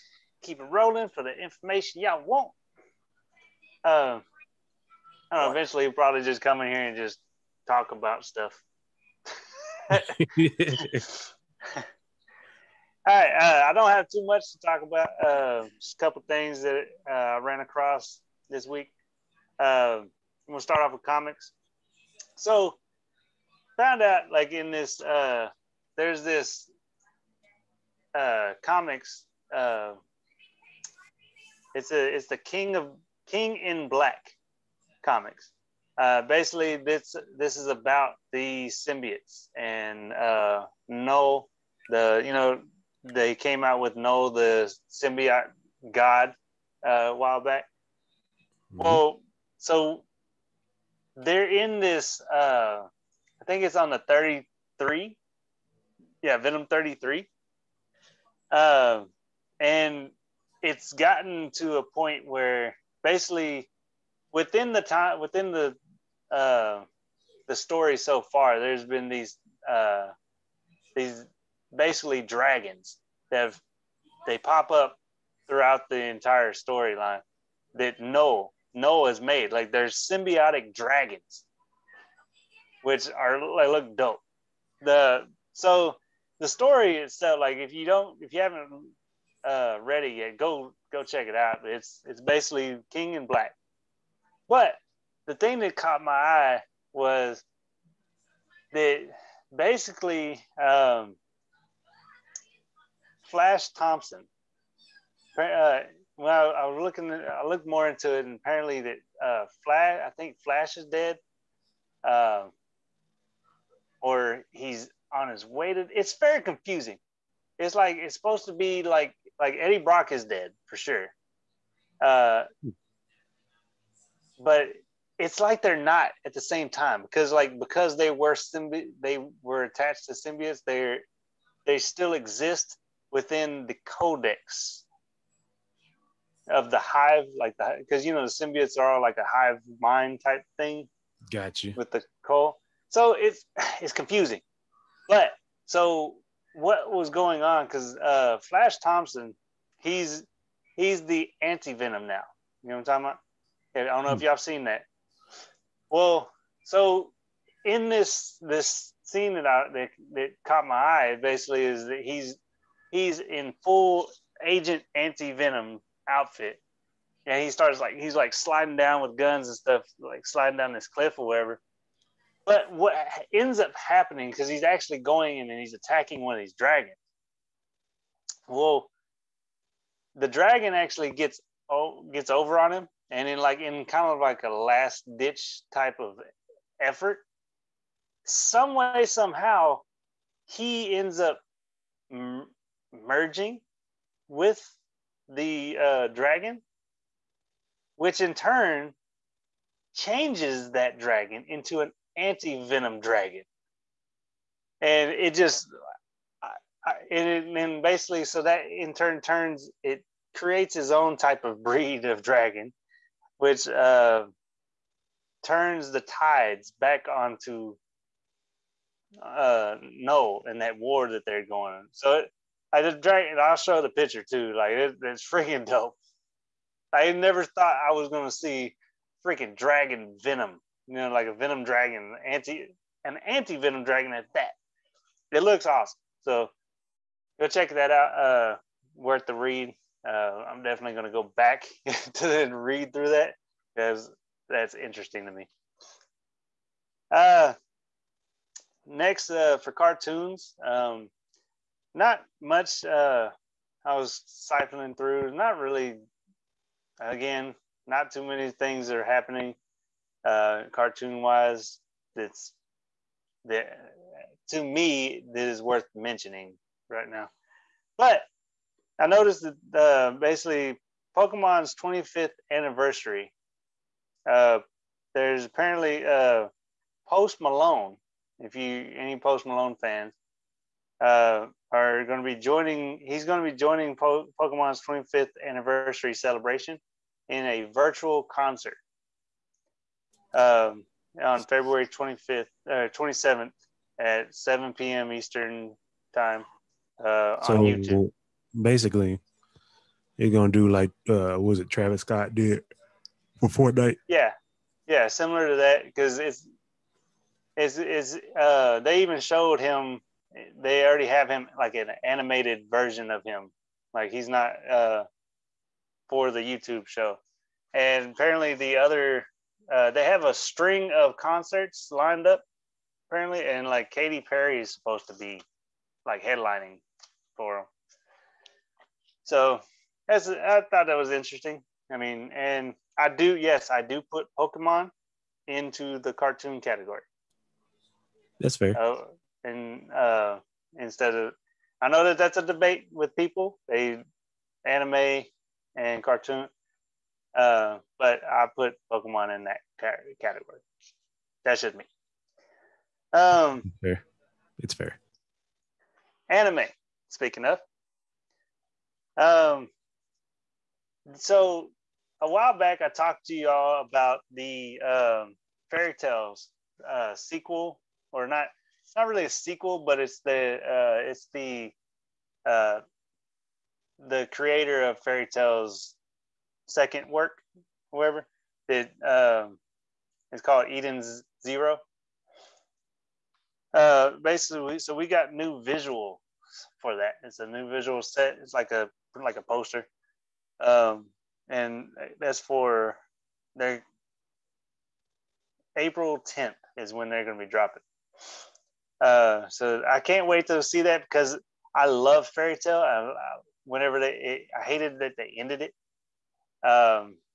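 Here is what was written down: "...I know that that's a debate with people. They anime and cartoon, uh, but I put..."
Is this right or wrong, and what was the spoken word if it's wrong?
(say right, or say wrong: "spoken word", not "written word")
right.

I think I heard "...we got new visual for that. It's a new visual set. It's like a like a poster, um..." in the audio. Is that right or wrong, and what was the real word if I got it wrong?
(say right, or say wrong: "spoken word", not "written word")
right.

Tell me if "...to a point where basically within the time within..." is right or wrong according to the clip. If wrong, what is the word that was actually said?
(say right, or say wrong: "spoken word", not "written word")
right.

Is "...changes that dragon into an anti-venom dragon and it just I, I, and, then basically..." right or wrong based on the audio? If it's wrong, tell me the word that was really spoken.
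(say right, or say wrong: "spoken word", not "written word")
right.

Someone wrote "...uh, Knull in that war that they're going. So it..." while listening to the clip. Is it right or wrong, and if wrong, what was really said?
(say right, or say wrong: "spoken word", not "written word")
right.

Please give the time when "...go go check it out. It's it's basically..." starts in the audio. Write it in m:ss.
1:30.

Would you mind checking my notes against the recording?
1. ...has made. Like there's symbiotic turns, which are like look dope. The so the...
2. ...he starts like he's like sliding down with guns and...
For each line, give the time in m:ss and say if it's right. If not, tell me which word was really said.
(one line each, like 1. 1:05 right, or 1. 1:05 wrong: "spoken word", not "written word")
1. 1:19 wrong: "dragons", not "turns"
2. 2:47 right.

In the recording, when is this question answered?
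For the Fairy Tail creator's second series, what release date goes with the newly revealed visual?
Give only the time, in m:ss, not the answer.
6:35.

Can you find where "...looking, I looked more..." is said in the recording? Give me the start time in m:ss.
1:46.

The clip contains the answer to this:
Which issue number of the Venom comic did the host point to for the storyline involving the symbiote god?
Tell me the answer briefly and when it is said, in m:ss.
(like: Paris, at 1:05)
33, at 0:56.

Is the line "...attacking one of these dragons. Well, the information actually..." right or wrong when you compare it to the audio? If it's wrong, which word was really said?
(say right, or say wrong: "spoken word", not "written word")
wrong: "dragon", not "information".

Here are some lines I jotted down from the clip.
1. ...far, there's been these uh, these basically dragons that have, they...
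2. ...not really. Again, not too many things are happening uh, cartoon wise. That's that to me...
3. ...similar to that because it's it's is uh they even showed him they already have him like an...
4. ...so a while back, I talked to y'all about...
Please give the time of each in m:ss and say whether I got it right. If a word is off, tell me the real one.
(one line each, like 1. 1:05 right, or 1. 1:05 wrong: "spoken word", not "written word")
1. 1:08 right
2. 4:15 right
3. 5:05 right
4. 6:01 right.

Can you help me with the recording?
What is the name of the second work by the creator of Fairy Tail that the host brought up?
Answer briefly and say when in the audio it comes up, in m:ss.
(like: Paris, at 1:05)
Eden's Zero, at 6:20.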